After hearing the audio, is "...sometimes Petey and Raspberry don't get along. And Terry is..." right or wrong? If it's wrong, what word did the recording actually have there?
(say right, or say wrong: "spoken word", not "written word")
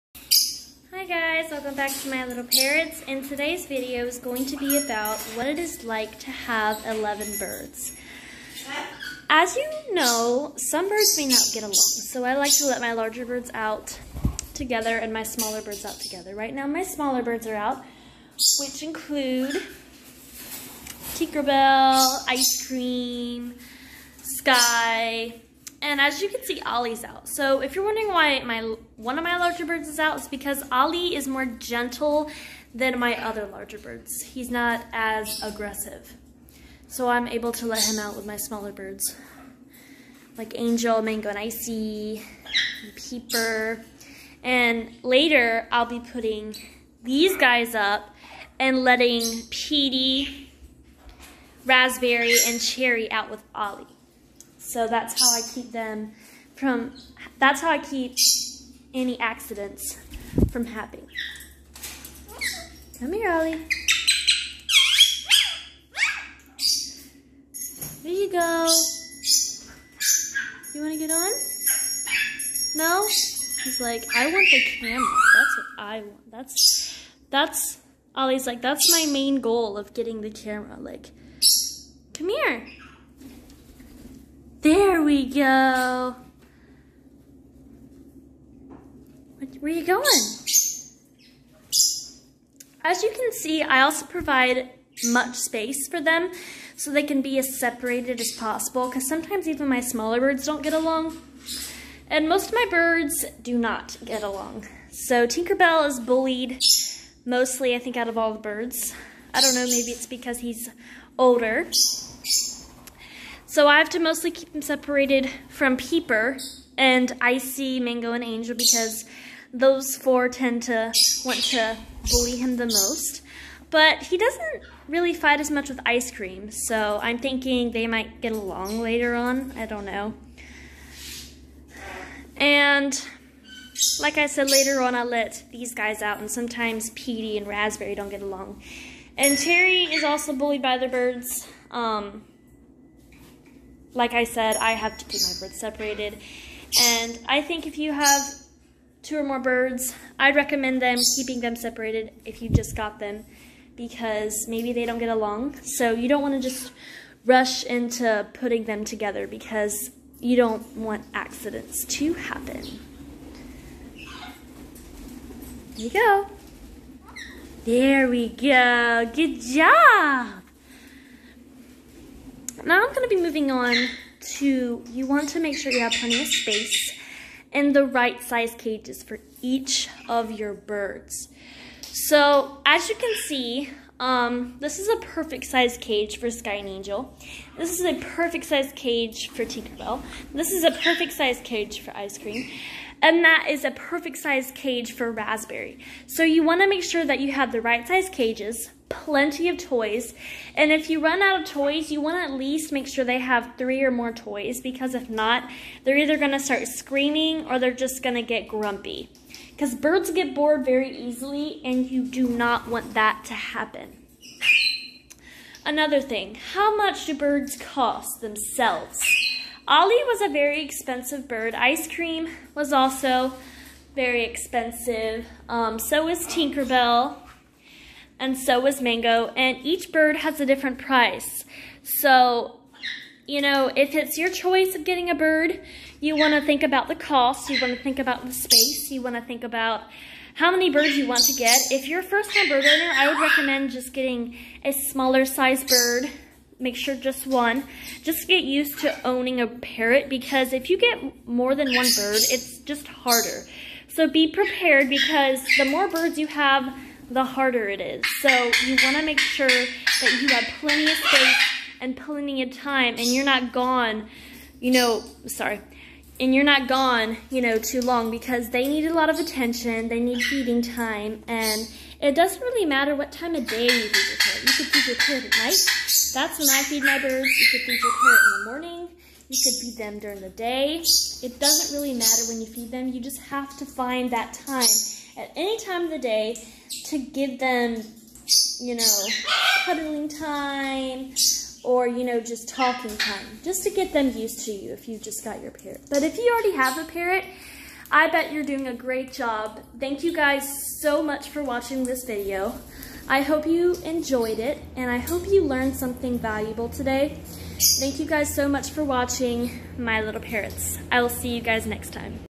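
right.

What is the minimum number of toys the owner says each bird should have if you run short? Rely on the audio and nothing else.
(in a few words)
3.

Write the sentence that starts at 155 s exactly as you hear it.
So you don't want to just rush into putting them together because you don't want accidents to happen.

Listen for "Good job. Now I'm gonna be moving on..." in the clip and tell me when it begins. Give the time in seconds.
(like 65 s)
169 s.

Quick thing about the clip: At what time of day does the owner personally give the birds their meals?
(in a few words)
At night.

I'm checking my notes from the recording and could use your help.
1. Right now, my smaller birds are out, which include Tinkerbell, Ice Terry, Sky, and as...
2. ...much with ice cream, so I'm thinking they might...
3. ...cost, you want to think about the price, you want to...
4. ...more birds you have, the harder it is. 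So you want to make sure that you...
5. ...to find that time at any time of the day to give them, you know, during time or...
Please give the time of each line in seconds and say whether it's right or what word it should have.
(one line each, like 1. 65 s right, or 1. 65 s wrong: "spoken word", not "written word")
1. 16 s wrong: "Cream", not "Terry"
2. 125 s right
3. 236 s wrong: "space", not "price"
4. 255 s right
5. 283 s wrong: "cuddling", not "during".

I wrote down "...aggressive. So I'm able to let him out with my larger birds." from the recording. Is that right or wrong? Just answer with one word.
wrong.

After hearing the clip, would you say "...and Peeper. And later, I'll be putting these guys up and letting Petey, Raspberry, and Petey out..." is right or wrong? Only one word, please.
wrong.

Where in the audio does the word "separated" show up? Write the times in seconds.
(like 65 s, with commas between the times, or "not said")
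97 s, 114 s, 145 s, 151 s.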